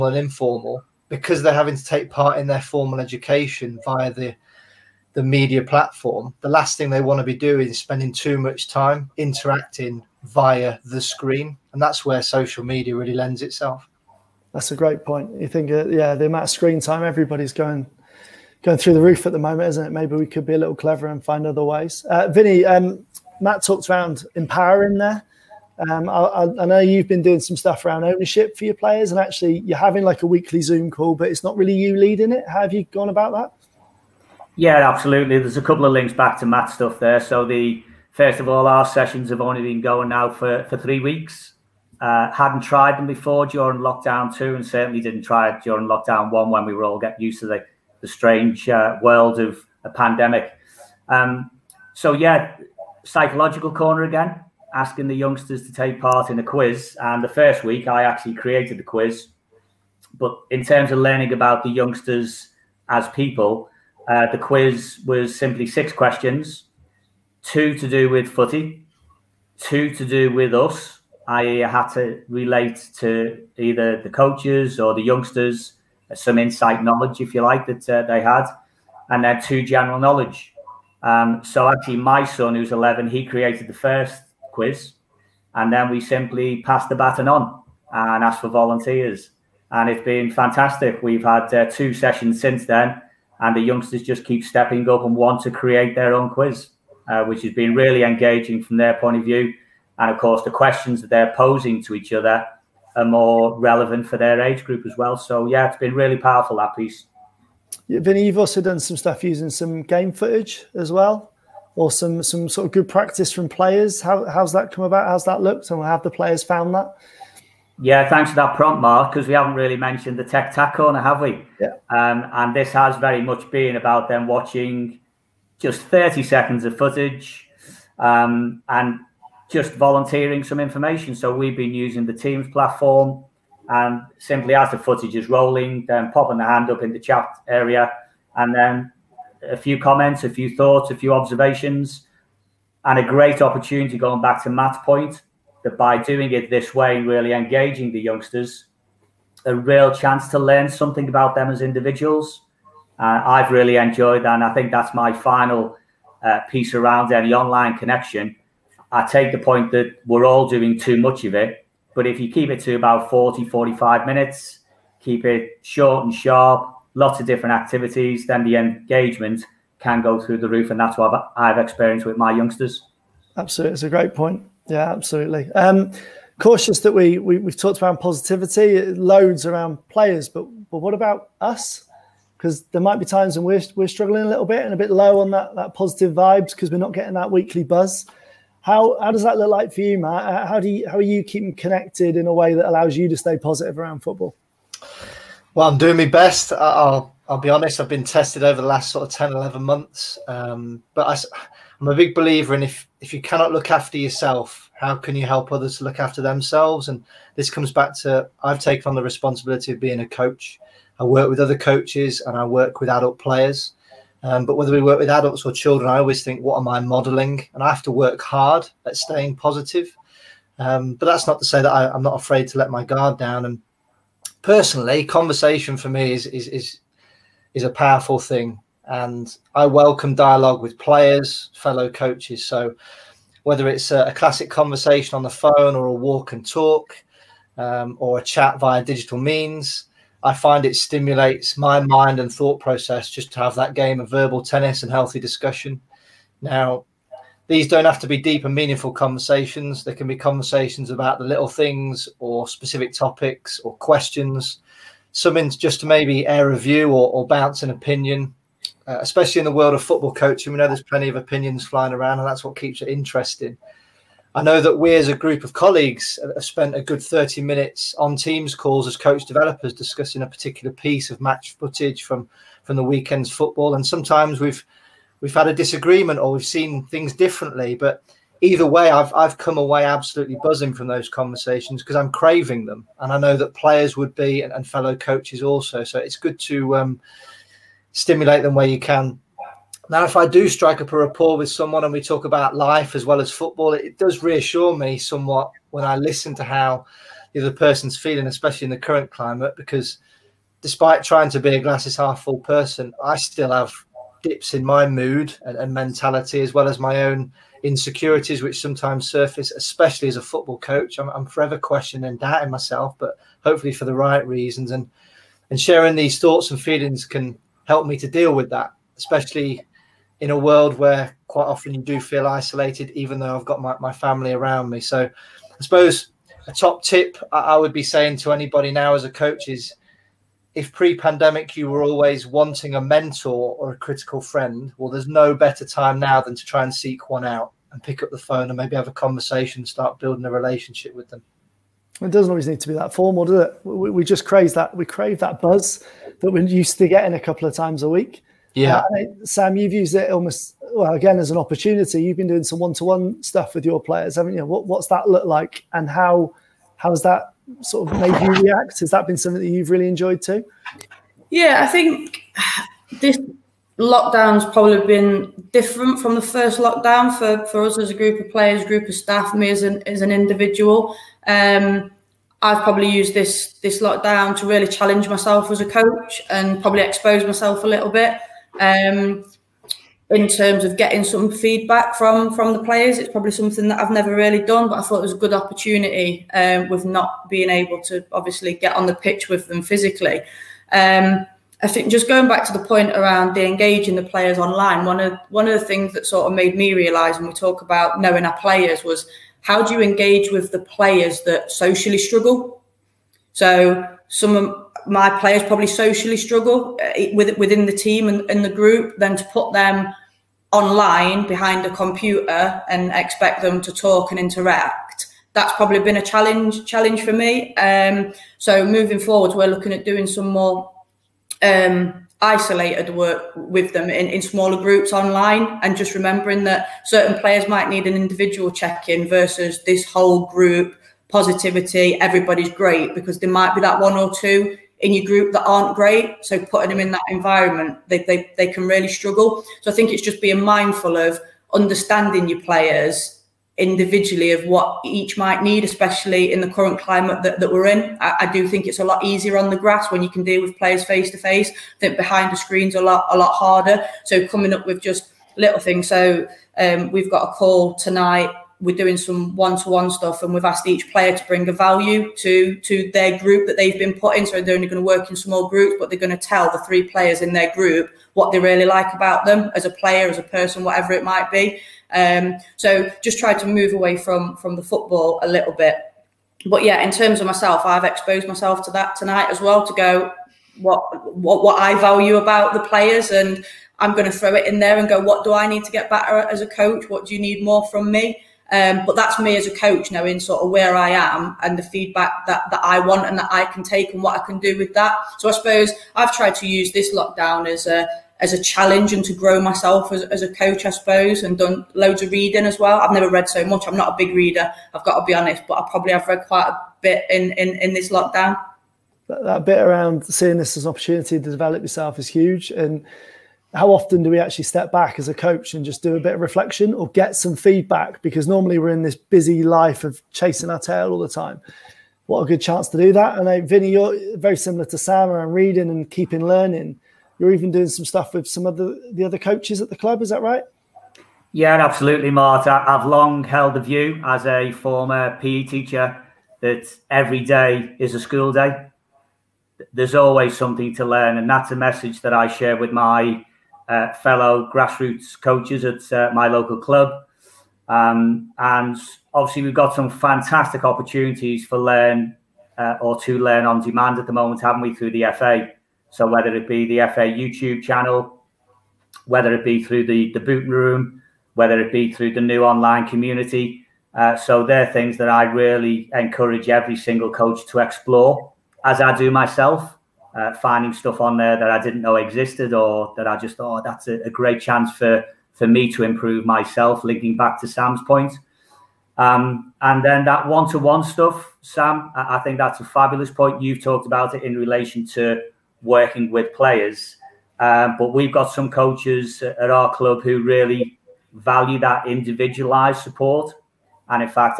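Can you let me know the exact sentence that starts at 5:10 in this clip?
I'm, I'm forever questioning and doubting myself, but hopefully for the right reasons.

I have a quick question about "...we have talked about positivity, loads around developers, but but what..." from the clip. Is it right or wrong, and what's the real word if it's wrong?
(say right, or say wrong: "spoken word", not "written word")
wrong: "players", not "developers".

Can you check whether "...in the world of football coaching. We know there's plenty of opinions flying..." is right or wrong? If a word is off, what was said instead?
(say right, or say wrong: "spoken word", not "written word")
right.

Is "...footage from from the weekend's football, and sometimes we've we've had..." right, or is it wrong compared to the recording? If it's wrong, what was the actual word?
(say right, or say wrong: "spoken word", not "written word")
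right.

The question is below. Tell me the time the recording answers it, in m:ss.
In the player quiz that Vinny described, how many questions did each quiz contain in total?
1:05.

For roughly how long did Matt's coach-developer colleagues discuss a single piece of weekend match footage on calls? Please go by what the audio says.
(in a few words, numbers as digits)
30 minutes.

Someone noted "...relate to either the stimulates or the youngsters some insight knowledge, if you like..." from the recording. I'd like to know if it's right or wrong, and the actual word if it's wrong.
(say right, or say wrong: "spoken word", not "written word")
wrong: "coaches", not "stimulates".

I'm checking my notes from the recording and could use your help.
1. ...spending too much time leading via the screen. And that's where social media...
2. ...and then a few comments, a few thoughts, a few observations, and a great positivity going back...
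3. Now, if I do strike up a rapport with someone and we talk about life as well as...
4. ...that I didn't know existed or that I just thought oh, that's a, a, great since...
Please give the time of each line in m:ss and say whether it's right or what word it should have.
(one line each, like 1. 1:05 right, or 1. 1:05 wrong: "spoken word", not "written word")
1. 0:07 wrong: "interacting", not "leading"
2. 2:18 wrong: "opportunity", not "positivity"
3. 4:49 right
4. 9:31 wrong: "chance", not "since".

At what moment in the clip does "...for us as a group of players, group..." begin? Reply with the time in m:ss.
6:07.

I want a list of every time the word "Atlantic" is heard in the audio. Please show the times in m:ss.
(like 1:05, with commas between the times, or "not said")
not said.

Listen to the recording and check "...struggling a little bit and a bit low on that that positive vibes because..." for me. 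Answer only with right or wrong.
right.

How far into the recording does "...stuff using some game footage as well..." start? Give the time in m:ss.
1:48.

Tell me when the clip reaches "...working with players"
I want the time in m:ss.
9:45.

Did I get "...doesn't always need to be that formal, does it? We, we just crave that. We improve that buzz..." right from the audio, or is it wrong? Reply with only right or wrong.
wrong.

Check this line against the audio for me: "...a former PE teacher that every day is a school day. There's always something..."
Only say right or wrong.
right.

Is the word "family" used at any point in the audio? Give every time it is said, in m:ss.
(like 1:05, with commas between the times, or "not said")
5:23.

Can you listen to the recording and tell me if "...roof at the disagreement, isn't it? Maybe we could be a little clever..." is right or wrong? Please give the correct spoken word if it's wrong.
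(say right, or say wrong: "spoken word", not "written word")
wrong: "moment", not "disagreement".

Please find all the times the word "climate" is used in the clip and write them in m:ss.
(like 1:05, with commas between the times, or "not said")
4:59, 7:26.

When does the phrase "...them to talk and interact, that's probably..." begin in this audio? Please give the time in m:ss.
6:53.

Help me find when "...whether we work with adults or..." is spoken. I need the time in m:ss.
3:34.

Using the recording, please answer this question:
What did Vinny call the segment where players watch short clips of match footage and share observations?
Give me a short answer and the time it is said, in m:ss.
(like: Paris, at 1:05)
Tech Tack Corner, at 2:00.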